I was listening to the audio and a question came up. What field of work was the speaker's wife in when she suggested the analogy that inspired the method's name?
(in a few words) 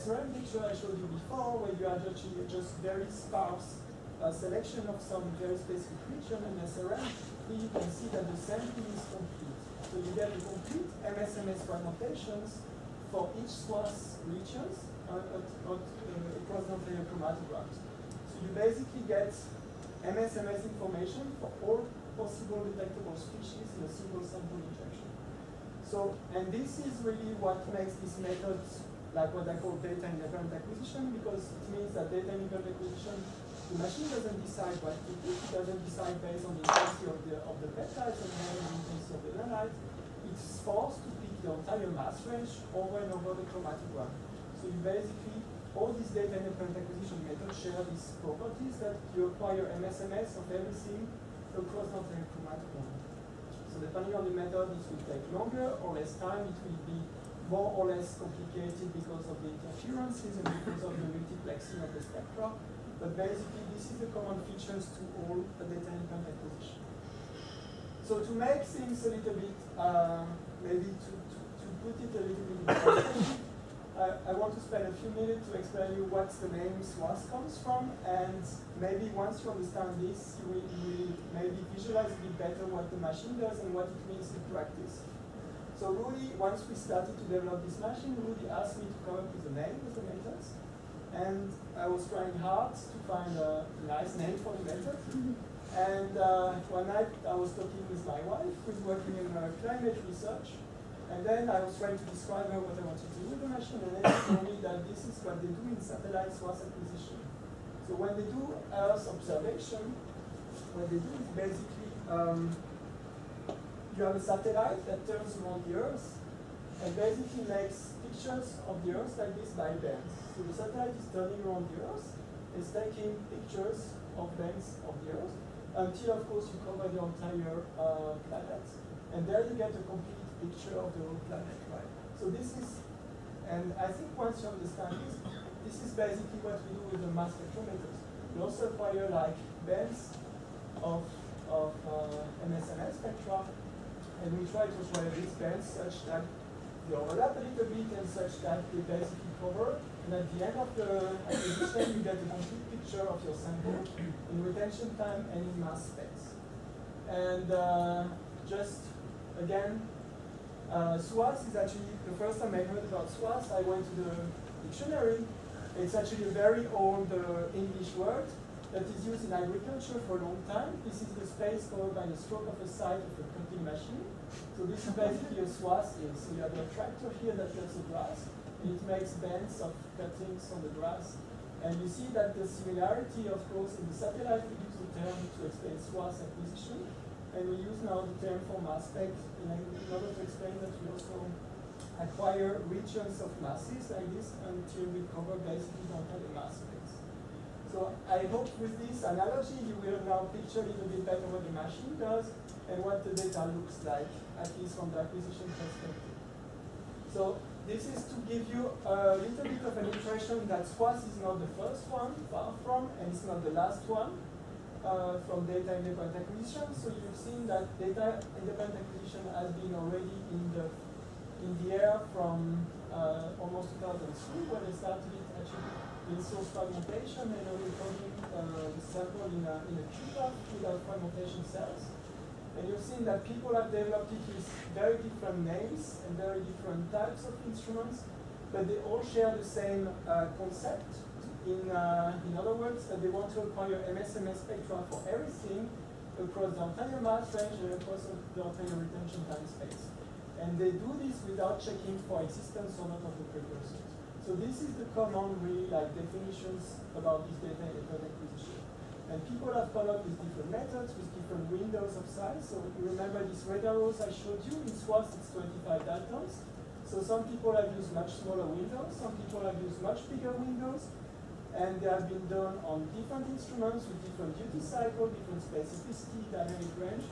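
Climate research.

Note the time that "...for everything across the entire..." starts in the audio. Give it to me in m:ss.
4:04.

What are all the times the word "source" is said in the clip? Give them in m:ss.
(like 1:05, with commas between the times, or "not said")
1:46, 3:46.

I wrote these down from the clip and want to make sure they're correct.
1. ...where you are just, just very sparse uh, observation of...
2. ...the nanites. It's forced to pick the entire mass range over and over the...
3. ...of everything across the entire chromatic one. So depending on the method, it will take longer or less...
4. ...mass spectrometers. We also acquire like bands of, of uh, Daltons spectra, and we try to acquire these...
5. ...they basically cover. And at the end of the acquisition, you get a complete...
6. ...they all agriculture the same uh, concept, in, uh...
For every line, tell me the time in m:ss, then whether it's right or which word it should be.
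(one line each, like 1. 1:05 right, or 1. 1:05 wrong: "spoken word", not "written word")
1. 0:01 wrong: "selection", not "observation"
2. 0:39 right
3. 0:50 right
4. 2:17 wrong: "MSMS", not "Daltons"
5. 2:28 right
6. 3:58 wrong: "share", not "agriculture".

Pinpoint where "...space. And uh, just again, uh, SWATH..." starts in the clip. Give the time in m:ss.
2:35.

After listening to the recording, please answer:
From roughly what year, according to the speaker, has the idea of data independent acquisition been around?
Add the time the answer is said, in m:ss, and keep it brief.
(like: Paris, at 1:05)
2003, at 3:43.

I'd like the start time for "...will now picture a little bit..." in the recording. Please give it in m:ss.
3:19.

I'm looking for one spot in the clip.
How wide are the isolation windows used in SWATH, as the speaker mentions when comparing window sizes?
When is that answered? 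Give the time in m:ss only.
4:25.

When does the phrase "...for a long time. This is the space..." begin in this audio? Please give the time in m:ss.
2:50.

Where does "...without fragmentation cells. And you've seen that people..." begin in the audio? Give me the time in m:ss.
3:50.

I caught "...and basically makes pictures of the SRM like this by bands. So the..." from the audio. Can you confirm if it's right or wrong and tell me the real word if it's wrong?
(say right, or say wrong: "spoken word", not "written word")
wrong: "Earth", not "SRM".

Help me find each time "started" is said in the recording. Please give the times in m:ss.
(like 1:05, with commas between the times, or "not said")
1:26, 3:44.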